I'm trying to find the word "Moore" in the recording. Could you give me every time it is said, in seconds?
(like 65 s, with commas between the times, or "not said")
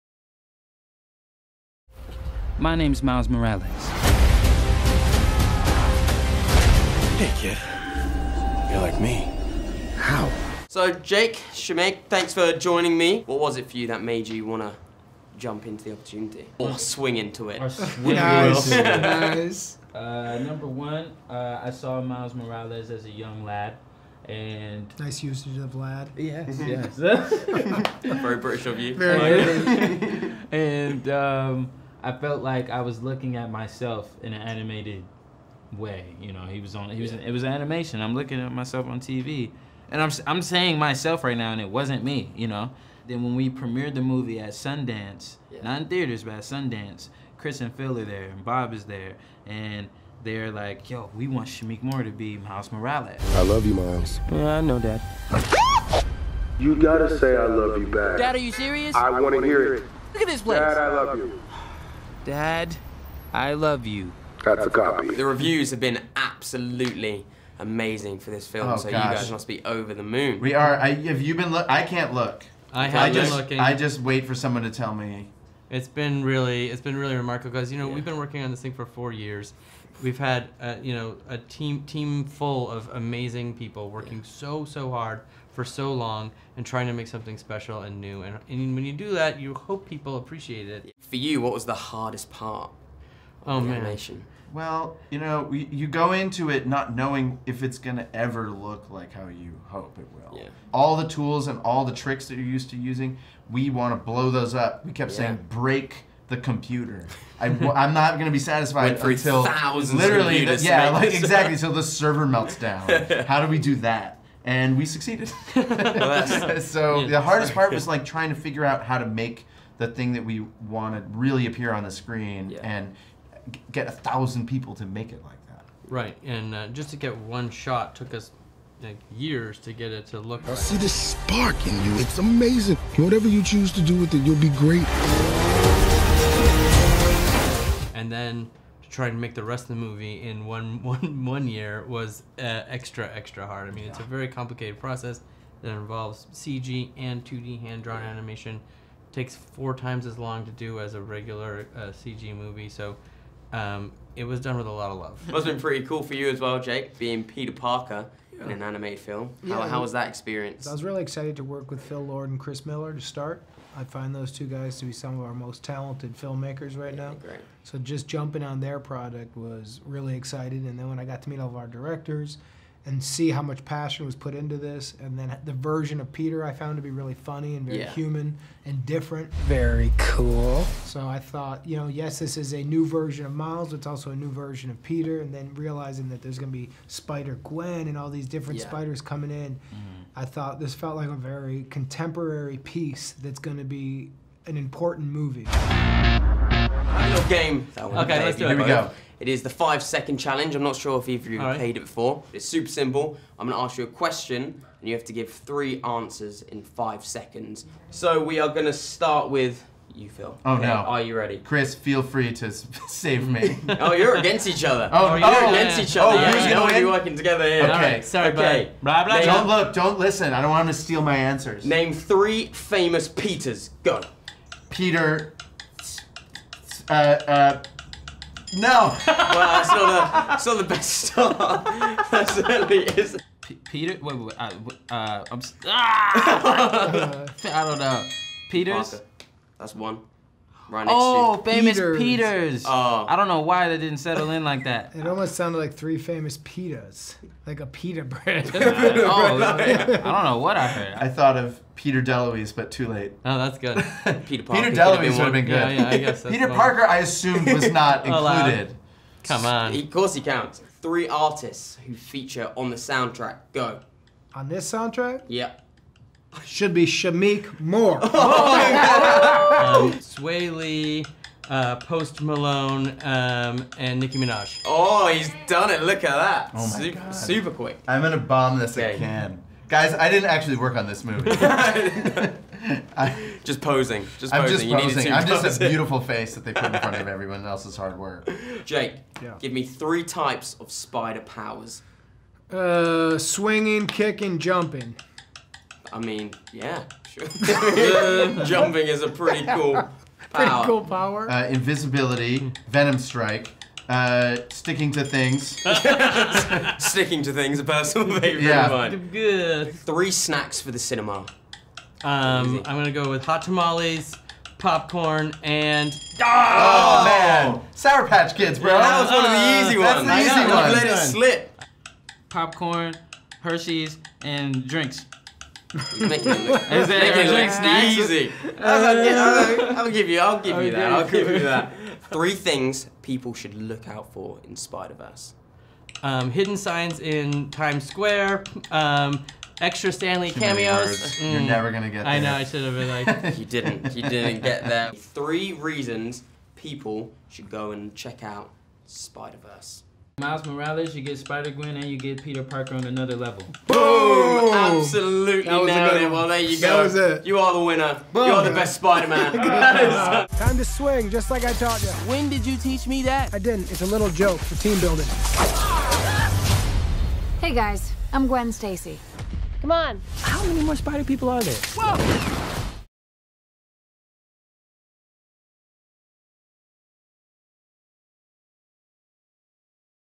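51 s, 267 s.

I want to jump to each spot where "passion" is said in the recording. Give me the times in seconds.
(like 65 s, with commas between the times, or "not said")
173 s.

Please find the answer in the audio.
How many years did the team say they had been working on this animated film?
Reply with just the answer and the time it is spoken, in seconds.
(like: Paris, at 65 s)
4, at 78 s.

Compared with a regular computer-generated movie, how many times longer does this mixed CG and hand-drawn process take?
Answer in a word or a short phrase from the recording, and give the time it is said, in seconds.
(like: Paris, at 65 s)
4, at 149 s.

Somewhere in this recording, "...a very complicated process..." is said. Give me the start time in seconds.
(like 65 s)
143 s.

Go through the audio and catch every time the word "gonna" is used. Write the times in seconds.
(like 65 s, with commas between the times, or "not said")
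312 s, 341 s.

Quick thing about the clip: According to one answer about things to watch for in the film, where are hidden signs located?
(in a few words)
Times Square.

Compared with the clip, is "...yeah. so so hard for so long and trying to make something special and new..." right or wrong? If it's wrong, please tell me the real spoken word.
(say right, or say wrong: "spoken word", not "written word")
right.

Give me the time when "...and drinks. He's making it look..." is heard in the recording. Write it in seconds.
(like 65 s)
324 s.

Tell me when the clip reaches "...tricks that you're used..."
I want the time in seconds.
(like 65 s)
101 s.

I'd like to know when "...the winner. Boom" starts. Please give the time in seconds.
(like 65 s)
357 s.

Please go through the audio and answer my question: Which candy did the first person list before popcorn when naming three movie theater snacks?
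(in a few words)
Hot Tamales.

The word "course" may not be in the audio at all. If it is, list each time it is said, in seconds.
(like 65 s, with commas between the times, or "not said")
259 s.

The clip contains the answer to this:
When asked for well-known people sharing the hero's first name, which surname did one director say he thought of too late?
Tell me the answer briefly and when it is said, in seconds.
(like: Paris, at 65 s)
DeLuise, at 251 s.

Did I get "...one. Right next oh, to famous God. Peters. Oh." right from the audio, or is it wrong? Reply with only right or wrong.
wrong.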